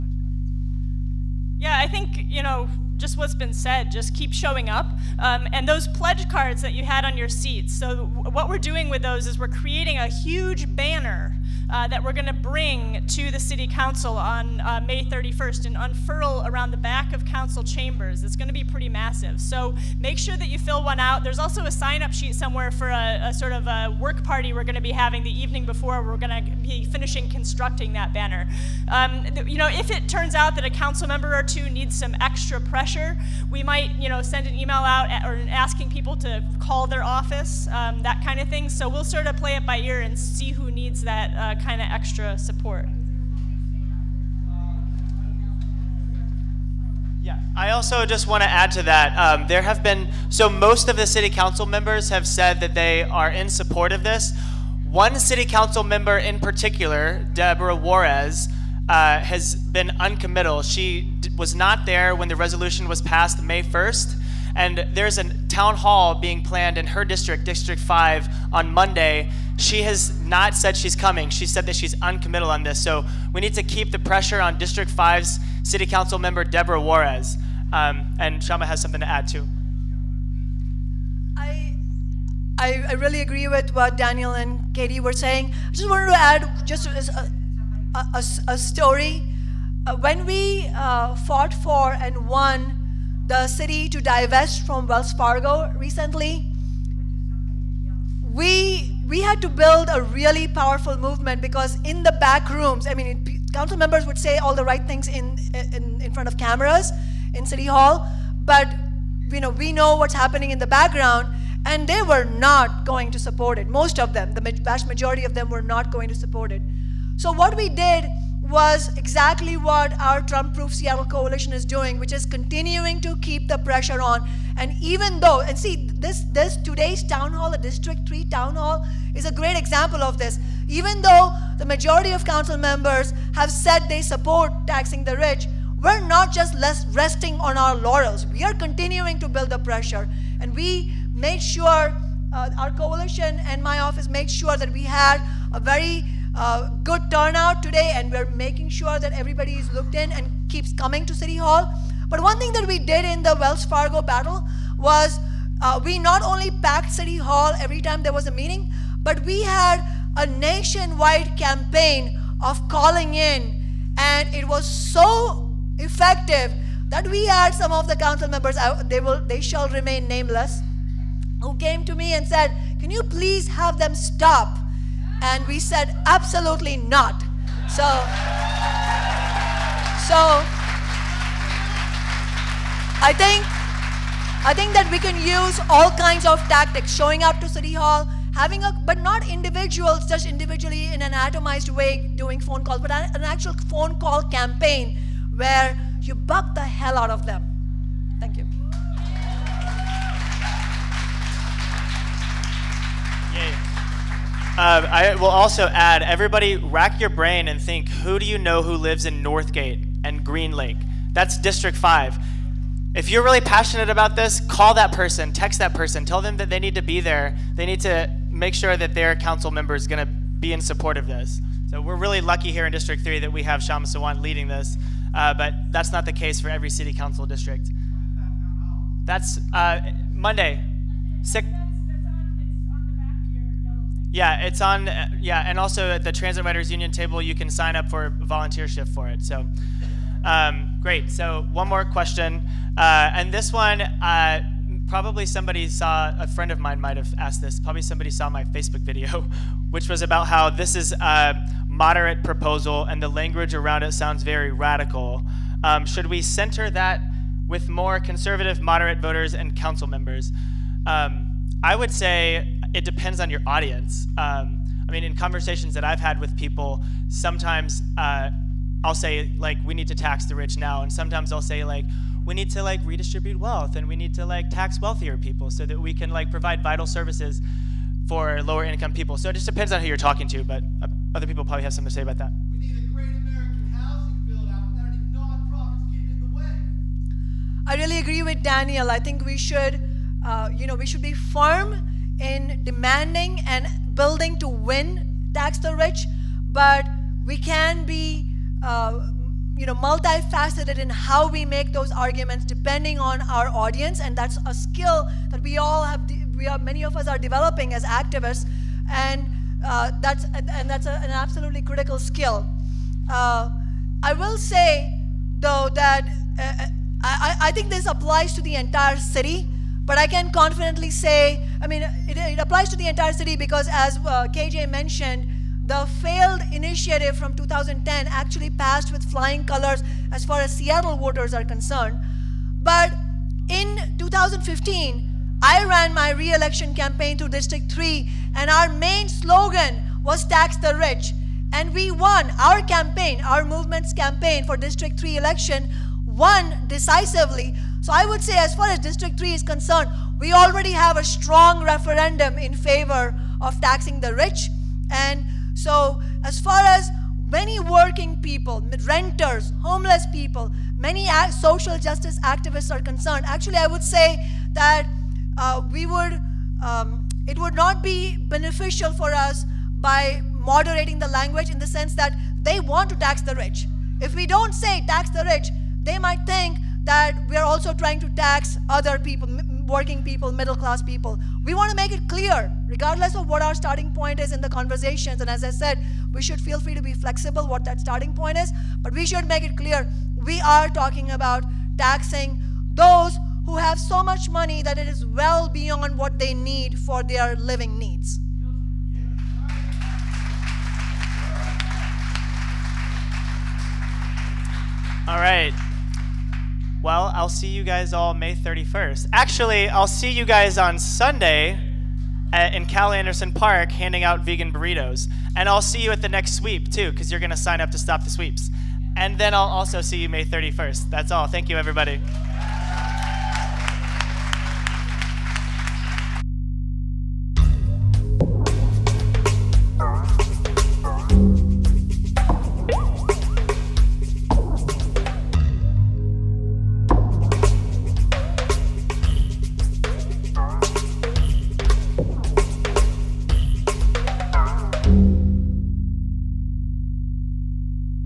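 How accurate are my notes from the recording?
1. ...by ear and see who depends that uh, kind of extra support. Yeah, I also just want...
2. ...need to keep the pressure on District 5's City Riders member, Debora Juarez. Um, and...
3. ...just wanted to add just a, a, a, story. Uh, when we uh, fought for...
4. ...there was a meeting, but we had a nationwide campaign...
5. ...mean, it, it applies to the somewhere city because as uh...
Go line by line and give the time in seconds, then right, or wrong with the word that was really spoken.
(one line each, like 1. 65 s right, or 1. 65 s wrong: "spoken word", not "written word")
1. 39 s wrong: "needs", not "depends"
2. 73 s wrong: "Council", not "Riders"
3. 85 s right
4. 158 s right
5. 321 s wrong: "entire", not "somewhere".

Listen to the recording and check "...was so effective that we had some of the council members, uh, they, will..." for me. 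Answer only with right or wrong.
right.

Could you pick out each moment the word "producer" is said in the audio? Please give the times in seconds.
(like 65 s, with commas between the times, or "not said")
not said.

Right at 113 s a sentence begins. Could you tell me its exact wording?
Most of them, the vast majority of them were not going to support it.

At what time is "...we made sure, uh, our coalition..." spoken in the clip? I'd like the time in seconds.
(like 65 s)
140 s.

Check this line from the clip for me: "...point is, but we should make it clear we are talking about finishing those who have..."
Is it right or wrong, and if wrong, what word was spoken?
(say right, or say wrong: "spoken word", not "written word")
wrong: "taxing", not "finishing".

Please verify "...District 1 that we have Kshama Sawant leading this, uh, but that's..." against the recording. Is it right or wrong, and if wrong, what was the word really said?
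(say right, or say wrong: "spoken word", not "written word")
wrong: "3", not "1".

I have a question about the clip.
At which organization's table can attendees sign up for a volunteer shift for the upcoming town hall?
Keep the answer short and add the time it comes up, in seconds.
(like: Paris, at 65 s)
Transit Riders Union, at 236 s.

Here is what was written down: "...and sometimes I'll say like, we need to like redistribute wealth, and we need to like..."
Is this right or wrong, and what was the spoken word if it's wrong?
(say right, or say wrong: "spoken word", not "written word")
right.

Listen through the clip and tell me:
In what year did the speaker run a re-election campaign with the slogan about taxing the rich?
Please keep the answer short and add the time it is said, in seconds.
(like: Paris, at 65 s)
2015, at 333 s.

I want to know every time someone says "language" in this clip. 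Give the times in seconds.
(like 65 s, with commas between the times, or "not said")
253 s, 371 s.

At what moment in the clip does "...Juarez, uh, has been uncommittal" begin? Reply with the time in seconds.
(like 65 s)
57 s.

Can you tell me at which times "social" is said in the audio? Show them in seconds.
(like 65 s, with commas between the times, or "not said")
361 s.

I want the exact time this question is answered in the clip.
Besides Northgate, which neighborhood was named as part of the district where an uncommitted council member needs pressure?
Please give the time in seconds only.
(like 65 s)
210 s.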